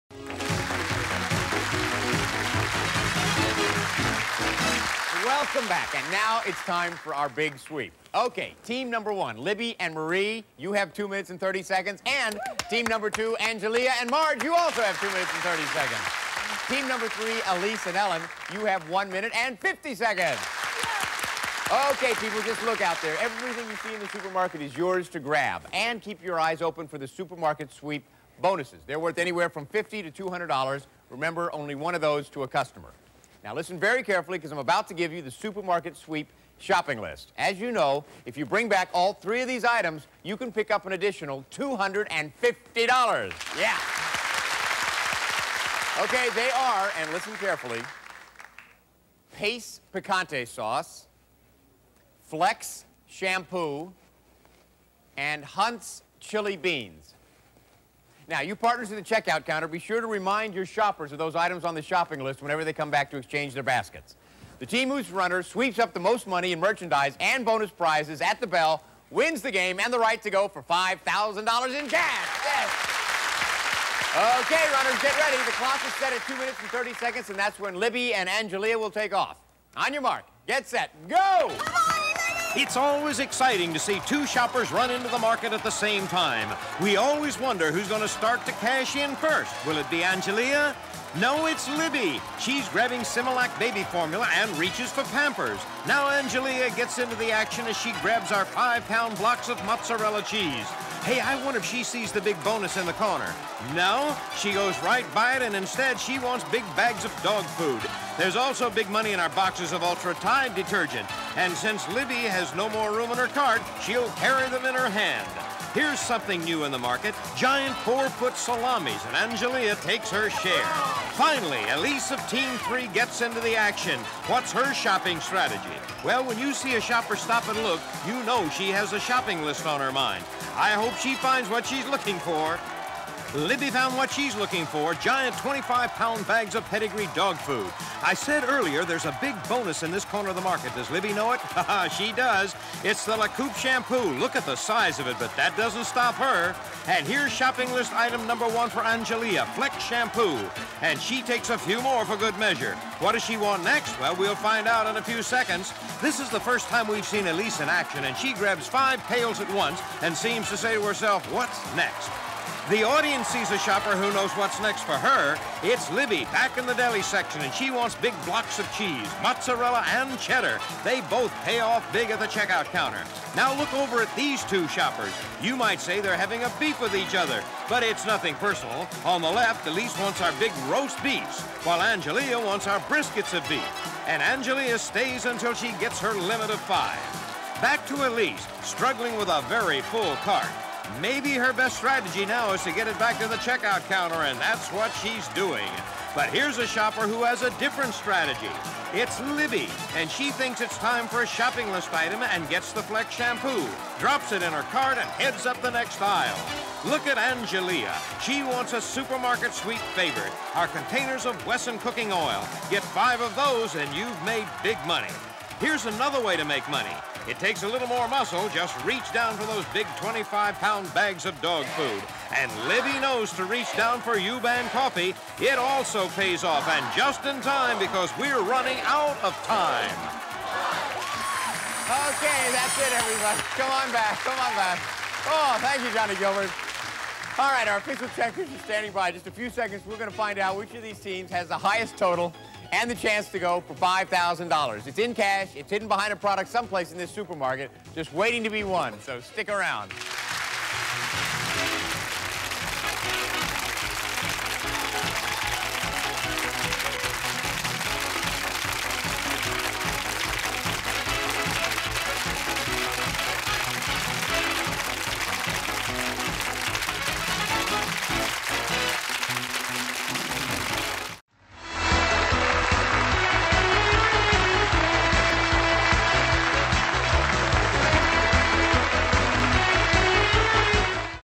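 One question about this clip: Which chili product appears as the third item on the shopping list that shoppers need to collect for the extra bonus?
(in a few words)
Hunt's Chili Beans.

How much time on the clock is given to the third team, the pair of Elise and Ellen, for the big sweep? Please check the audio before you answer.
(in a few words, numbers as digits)
1 minute 50 seconds.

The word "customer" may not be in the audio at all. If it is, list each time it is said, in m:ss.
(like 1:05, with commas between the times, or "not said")
0:32.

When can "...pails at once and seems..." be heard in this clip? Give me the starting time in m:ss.
2:39.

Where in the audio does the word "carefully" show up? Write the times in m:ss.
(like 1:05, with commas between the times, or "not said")
0:34, 0:47.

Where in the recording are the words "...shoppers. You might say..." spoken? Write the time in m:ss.
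2:54.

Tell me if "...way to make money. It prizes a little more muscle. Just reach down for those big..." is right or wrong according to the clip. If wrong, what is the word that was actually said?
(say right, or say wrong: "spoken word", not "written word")
wrong: "takes", not "prizes".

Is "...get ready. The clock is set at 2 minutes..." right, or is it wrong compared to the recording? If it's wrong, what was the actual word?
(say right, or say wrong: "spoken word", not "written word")
right.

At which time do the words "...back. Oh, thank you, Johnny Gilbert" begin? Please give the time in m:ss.
3:54.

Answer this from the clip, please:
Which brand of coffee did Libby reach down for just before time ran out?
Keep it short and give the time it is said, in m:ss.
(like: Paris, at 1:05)
Yuban, at 3:44.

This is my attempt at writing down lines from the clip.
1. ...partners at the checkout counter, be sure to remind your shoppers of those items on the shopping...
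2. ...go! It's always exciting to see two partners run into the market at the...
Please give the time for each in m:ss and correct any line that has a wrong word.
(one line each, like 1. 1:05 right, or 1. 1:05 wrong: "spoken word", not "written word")
1. 0:58 right
2. 1:21 wrong: "shoppers", not "partners".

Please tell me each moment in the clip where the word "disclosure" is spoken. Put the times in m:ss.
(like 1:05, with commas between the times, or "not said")
not said.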